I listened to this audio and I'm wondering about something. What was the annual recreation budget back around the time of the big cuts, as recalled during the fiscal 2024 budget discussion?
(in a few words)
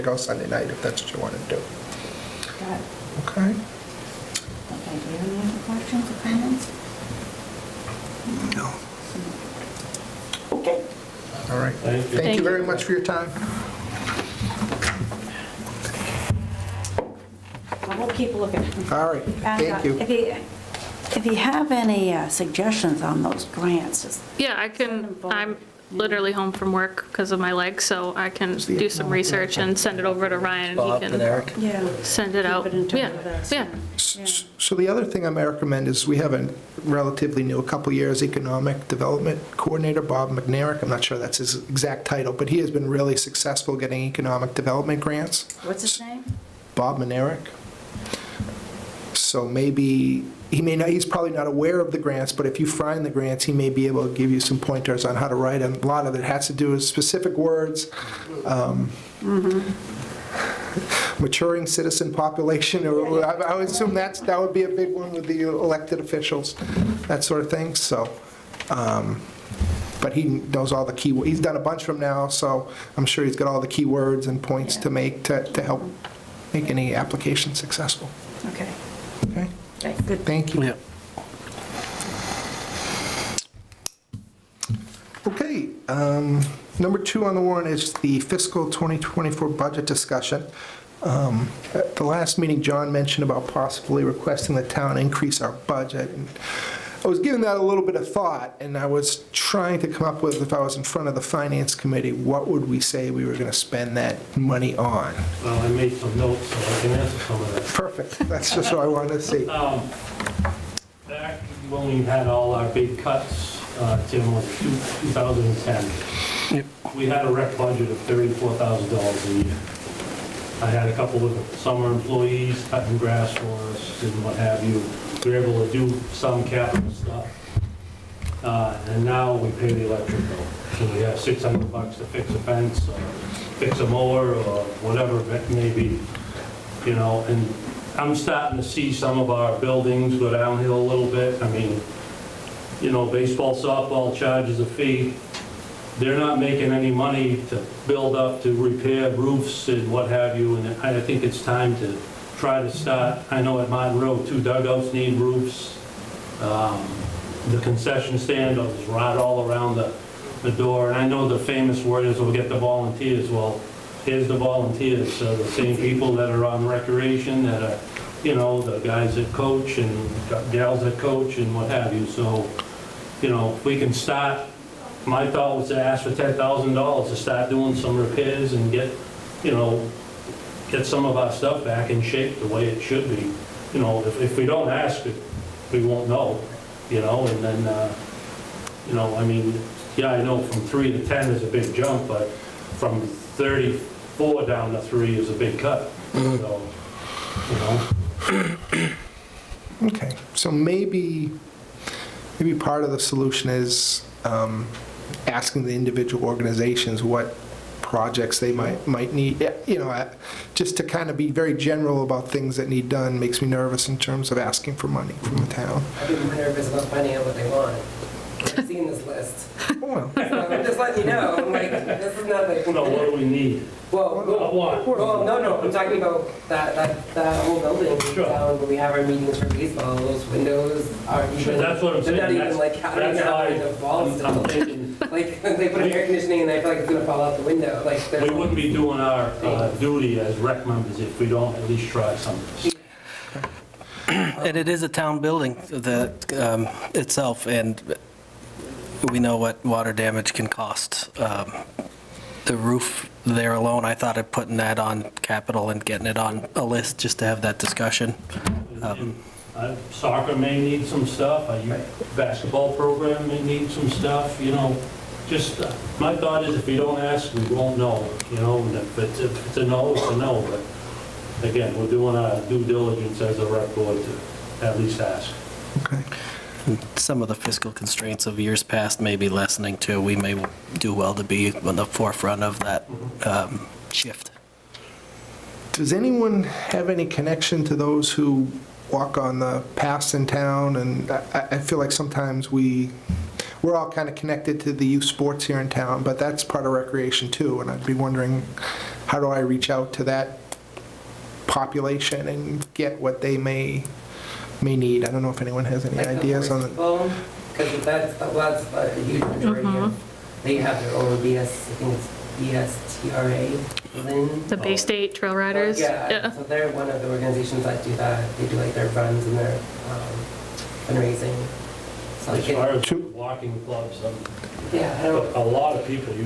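$34,000.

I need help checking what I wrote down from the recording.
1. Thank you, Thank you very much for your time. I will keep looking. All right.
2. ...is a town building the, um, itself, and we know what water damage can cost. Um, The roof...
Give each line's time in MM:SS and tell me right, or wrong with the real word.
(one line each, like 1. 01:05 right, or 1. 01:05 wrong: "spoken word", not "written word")
1. 00:11 right
2. 04:04 right.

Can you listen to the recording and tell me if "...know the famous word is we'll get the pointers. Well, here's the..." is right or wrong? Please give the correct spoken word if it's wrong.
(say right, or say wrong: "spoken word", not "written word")
wrong: "volunteers", not "pointers".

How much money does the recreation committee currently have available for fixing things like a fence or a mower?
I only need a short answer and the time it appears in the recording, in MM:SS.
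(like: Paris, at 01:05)
$600, at 02:11.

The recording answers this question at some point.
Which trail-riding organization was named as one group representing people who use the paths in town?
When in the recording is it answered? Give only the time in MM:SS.
05:14.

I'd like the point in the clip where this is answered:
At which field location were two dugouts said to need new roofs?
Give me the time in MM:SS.
02:33.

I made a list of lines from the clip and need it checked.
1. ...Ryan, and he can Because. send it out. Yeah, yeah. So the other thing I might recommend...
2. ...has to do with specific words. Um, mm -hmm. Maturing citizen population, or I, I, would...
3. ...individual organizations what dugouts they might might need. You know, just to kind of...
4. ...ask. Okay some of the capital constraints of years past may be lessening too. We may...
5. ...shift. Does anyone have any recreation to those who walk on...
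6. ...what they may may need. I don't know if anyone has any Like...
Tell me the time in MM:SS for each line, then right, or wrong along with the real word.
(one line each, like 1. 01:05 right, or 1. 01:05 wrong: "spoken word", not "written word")
1. 00:30 wrong: "Yeah", not "Because"
2. 00:56 right
3. 03:25 wrong: "projects", not "dugouts"
4. 04:34 wrong: "fiscal", not "capital"
5. 04:43 wrong: "connection", not "recreation"
6. 05:03 right.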